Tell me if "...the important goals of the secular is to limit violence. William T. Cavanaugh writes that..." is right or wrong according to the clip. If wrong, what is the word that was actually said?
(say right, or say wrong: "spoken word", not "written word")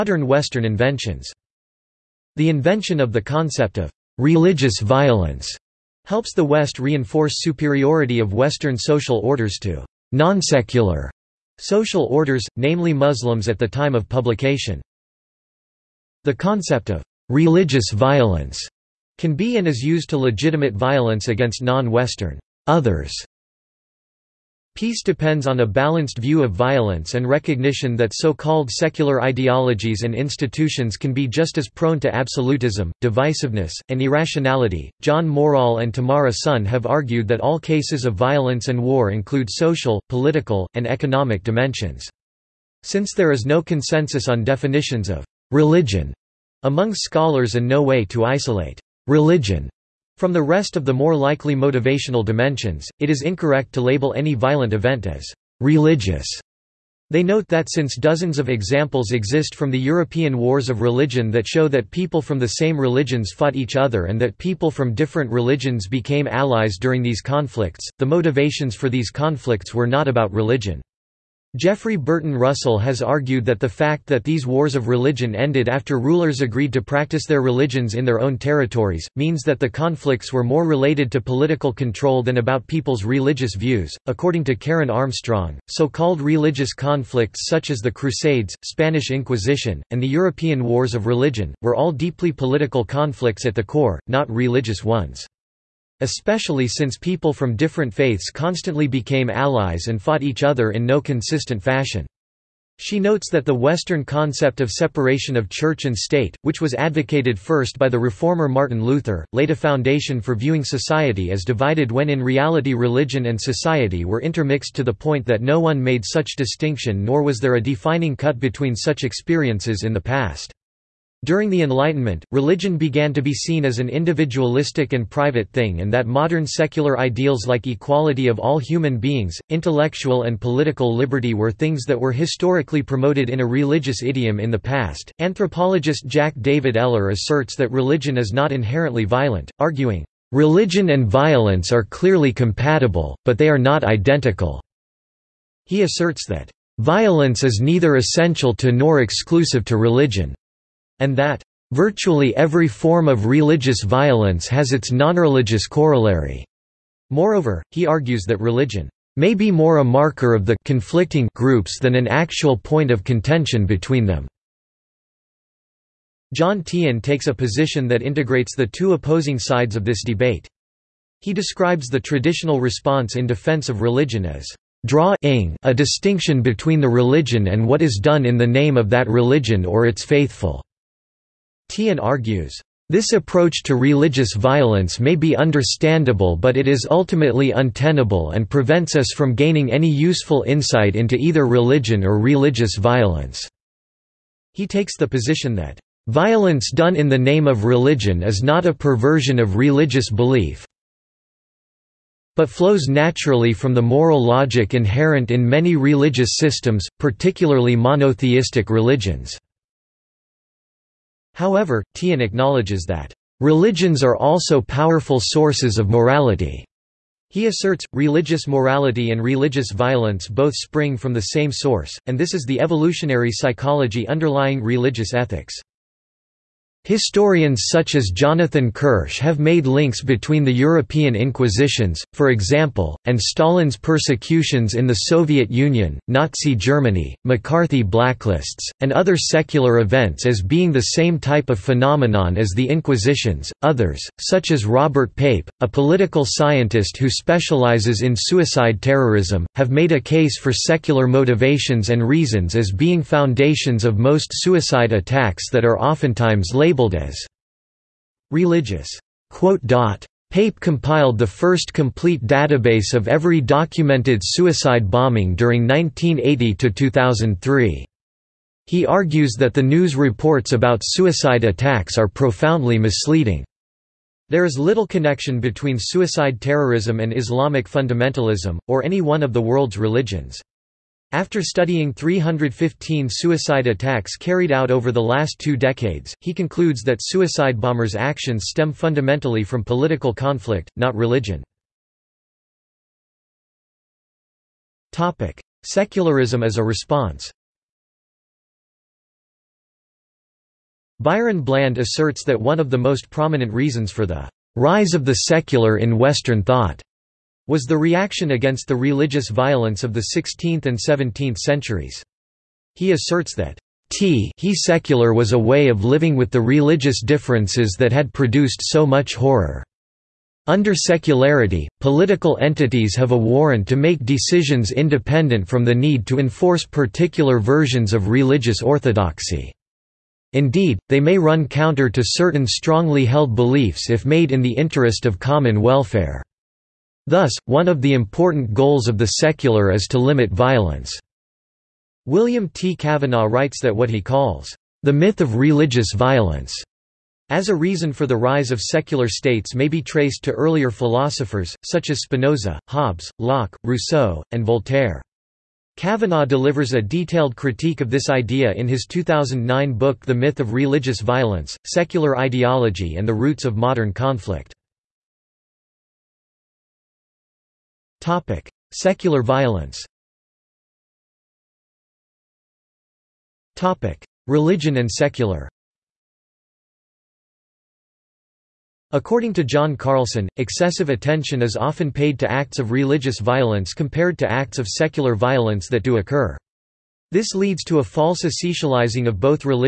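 right.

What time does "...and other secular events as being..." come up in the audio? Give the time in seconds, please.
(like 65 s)
238 s.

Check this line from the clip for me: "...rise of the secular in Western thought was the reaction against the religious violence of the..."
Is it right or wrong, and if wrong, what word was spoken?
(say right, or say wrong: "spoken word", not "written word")
right.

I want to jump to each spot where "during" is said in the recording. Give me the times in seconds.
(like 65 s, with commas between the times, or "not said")
66 s, 121 s, 265 s.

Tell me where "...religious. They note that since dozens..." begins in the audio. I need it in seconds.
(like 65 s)
55 s.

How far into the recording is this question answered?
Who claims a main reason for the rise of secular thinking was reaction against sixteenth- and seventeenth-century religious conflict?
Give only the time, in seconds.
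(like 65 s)
300 s.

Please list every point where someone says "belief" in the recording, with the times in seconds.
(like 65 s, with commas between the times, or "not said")
200 s, 333 s.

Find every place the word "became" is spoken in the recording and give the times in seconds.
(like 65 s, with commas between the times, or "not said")
65 s, 98 s.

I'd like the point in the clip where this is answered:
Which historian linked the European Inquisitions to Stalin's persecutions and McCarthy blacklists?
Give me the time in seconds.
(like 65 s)
228 s.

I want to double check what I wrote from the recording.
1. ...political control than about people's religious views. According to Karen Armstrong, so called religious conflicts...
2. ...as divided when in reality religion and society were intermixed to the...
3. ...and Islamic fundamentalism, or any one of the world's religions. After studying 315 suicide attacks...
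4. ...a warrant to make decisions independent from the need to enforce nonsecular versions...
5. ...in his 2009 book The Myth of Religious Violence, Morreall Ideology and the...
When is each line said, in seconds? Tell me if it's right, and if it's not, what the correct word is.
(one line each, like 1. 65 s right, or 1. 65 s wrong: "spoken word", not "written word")
1. 81 s right
2. 111 s right
3. 276 s right
4. 323 s wrong: "particular", not "nonsecular"
5. 358 s wrong: "Secular", not "Morreall".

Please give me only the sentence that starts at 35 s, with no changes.
John Morreall and Tamara Sonn have argued that all cases of violence and war include social, political, and economic dimensions.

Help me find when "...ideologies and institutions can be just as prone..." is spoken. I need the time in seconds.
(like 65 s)
29 s.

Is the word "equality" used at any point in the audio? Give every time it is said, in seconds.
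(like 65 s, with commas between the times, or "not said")
127 s.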